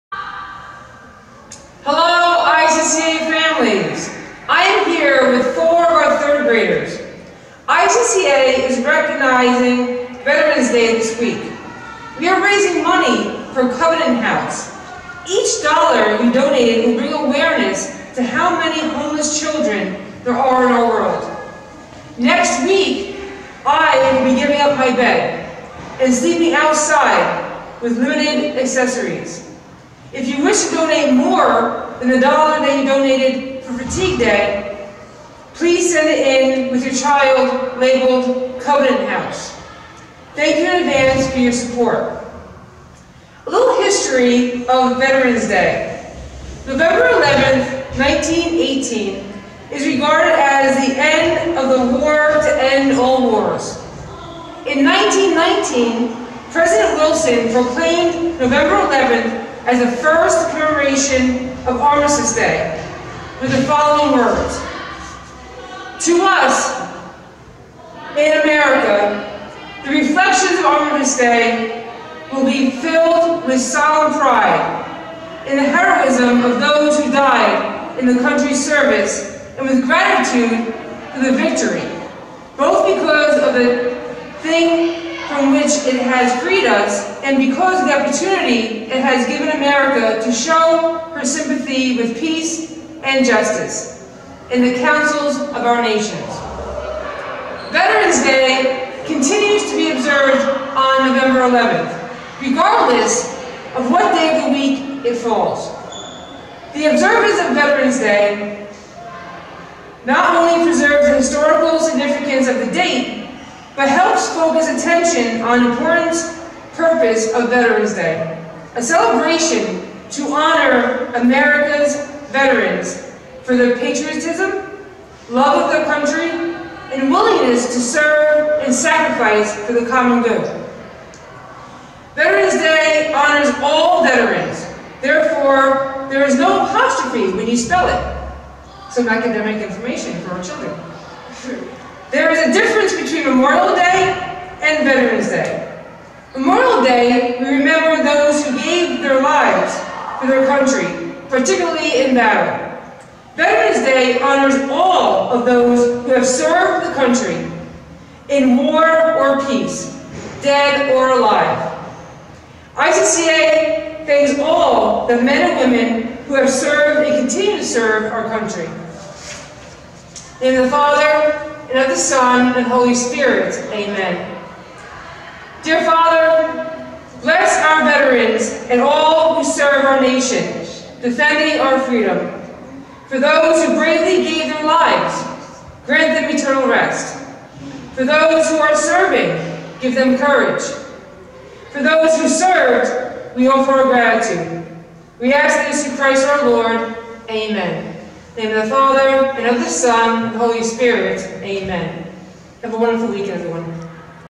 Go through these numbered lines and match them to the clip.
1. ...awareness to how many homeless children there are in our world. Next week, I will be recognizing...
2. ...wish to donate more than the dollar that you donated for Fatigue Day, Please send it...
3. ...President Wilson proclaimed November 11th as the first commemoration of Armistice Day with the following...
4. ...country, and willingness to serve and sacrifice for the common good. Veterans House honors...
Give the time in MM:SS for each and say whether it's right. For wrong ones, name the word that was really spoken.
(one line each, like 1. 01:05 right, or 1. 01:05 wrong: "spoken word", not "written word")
1. 00:17 wrong: "giving", not "recognizing"
2. 00:30 right
3. 00:56 right
4. 02:05 wrong: "Day", not "House".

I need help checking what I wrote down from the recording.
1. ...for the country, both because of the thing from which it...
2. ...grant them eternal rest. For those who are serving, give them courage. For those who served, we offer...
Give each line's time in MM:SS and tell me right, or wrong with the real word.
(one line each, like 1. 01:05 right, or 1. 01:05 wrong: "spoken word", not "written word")
1. 01:21 wrong: "victory", not "country"
2. 03:05 right.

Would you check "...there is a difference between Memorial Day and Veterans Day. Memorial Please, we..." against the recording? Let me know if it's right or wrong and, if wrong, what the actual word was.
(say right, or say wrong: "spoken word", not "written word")
wrong: "Day", not "Please".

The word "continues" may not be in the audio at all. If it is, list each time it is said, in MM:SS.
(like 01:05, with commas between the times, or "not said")
01:39, 02:47.